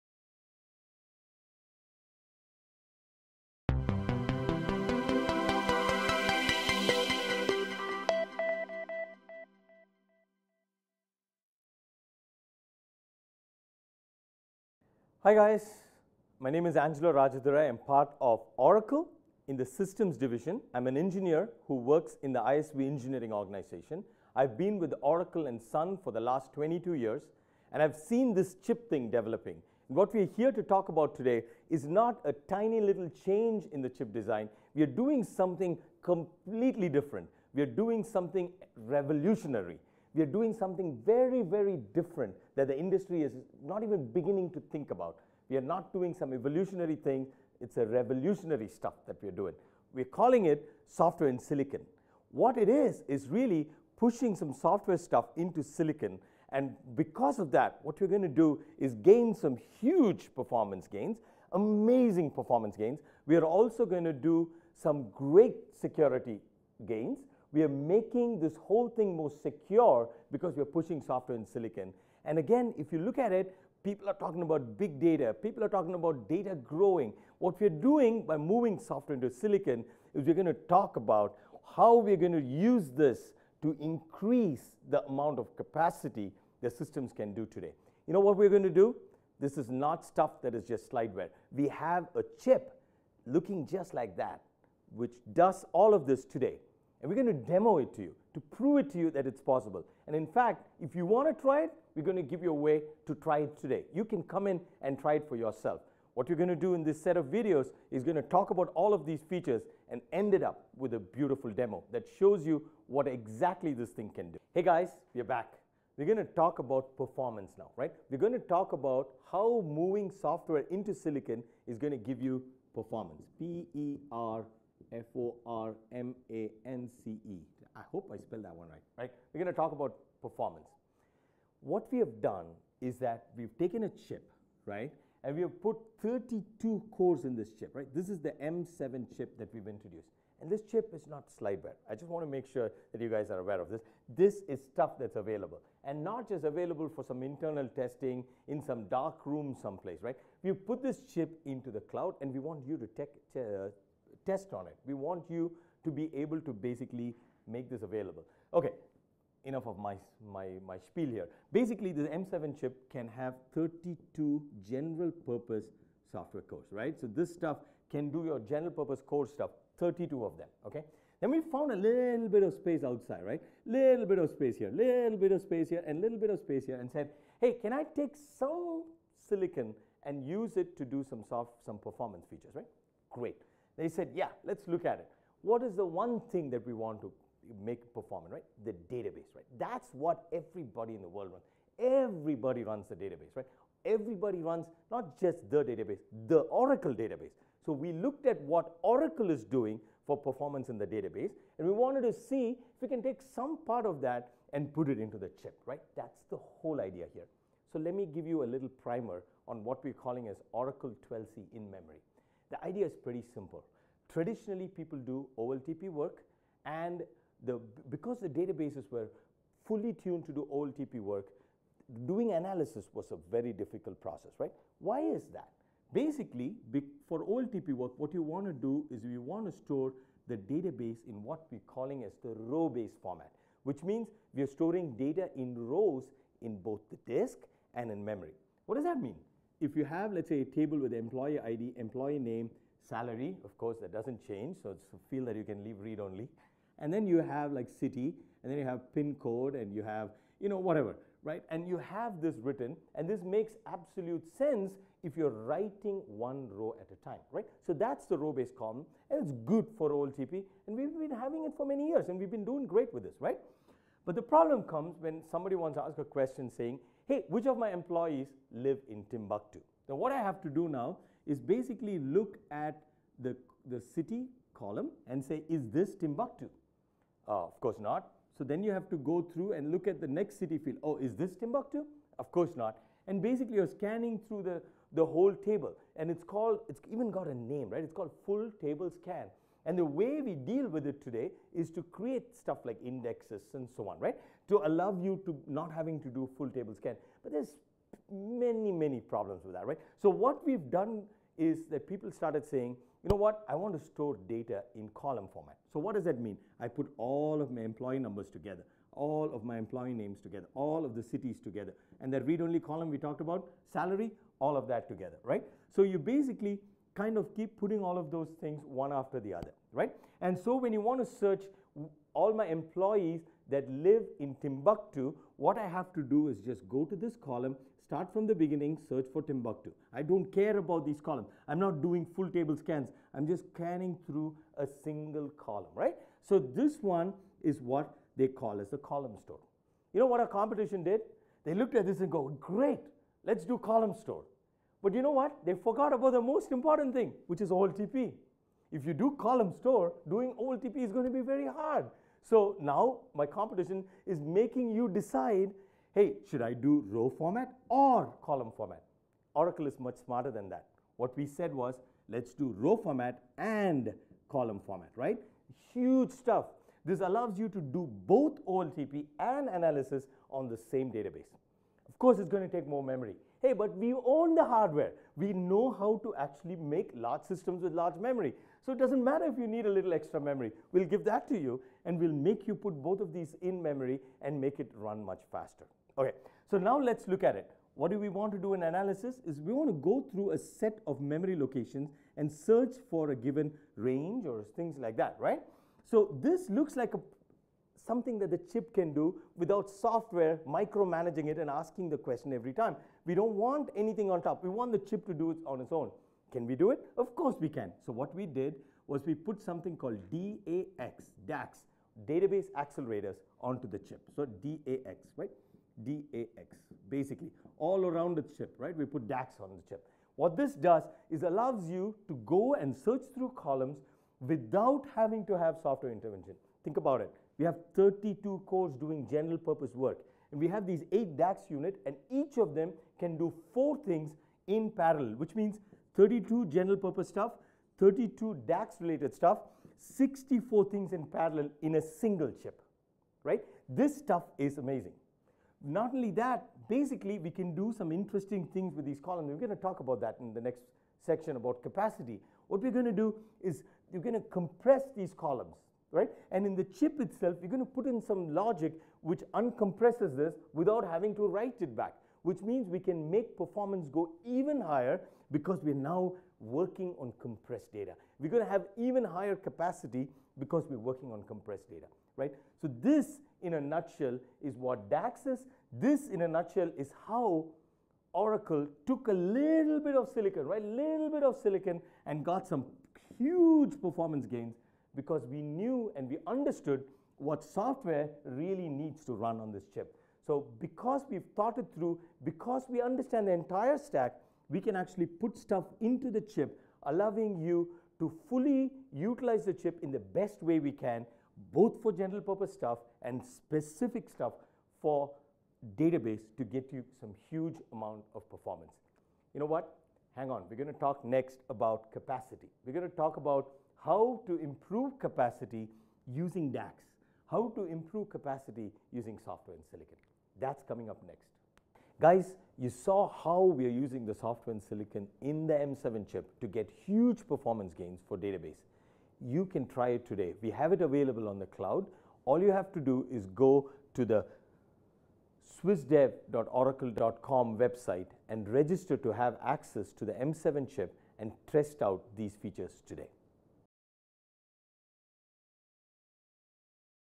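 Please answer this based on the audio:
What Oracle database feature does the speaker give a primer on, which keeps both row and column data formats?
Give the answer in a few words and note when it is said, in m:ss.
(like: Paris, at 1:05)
Oracle 12c in memory, at 3:30.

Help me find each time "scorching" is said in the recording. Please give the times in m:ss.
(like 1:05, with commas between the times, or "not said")
not said.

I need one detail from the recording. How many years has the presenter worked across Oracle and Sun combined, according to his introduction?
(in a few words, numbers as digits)
22.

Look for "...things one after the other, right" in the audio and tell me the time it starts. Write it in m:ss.
5:18.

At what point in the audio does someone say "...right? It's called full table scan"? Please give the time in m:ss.
4:47.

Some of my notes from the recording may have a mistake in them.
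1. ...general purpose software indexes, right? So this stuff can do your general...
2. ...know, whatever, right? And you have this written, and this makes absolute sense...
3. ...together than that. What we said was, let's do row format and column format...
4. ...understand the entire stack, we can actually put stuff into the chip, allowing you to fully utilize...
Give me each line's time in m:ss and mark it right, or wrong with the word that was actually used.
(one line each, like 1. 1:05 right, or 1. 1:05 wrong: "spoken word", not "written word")
1. 2:44 wrong: "cores", not "indexes"
2. 4:10 right
3. 6:00 wrong: "smarter", not "together"
4. 8:12 right.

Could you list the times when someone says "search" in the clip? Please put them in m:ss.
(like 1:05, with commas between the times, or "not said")
5:21, 5:28, 6:32, 7:02.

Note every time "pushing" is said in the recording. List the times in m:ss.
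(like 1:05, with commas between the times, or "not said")
0:53, 1:10.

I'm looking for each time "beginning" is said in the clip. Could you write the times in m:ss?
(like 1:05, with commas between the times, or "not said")
0:44, 5:28.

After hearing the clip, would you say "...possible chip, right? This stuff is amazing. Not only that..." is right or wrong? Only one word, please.
wrong.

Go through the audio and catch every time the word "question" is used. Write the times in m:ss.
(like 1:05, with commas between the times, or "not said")
4:26, 6:41.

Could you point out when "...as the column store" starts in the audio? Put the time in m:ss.
5:38.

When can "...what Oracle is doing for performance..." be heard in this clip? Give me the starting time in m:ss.
3:18.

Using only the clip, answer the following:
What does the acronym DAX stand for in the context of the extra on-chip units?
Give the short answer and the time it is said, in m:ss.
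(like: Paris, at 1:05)
Database accelerators, at 6:52.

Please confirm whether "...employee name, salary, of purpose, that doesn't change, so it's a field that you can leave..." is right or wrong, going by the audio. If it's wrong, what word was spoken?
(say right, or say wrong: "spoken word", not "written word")
wrong: "course", not "purpose".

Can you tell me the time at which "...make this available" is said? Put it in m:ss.
2:37.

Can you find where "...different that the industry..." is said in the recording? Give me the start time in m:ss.
0:41.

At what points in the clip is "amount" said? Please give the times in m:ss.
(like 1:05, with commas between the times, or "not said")
1:25, 8:27.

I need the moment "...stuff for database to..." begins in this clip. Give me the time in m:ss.
8:24.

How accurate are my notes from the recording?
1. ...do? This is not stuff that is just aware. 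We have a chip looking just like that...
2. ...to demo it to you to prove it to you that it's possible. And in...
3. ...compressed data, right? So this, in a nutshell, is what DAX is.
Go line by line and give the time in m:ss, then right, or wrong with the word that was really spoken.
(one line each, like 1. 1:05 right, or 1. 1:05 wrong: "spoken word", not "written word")
1. 1:28 wrong: "slideware", not "aware"
2. 1:37 right
3. 7:51 right.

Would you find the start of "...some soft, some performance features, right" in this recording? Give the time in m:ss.
3:01.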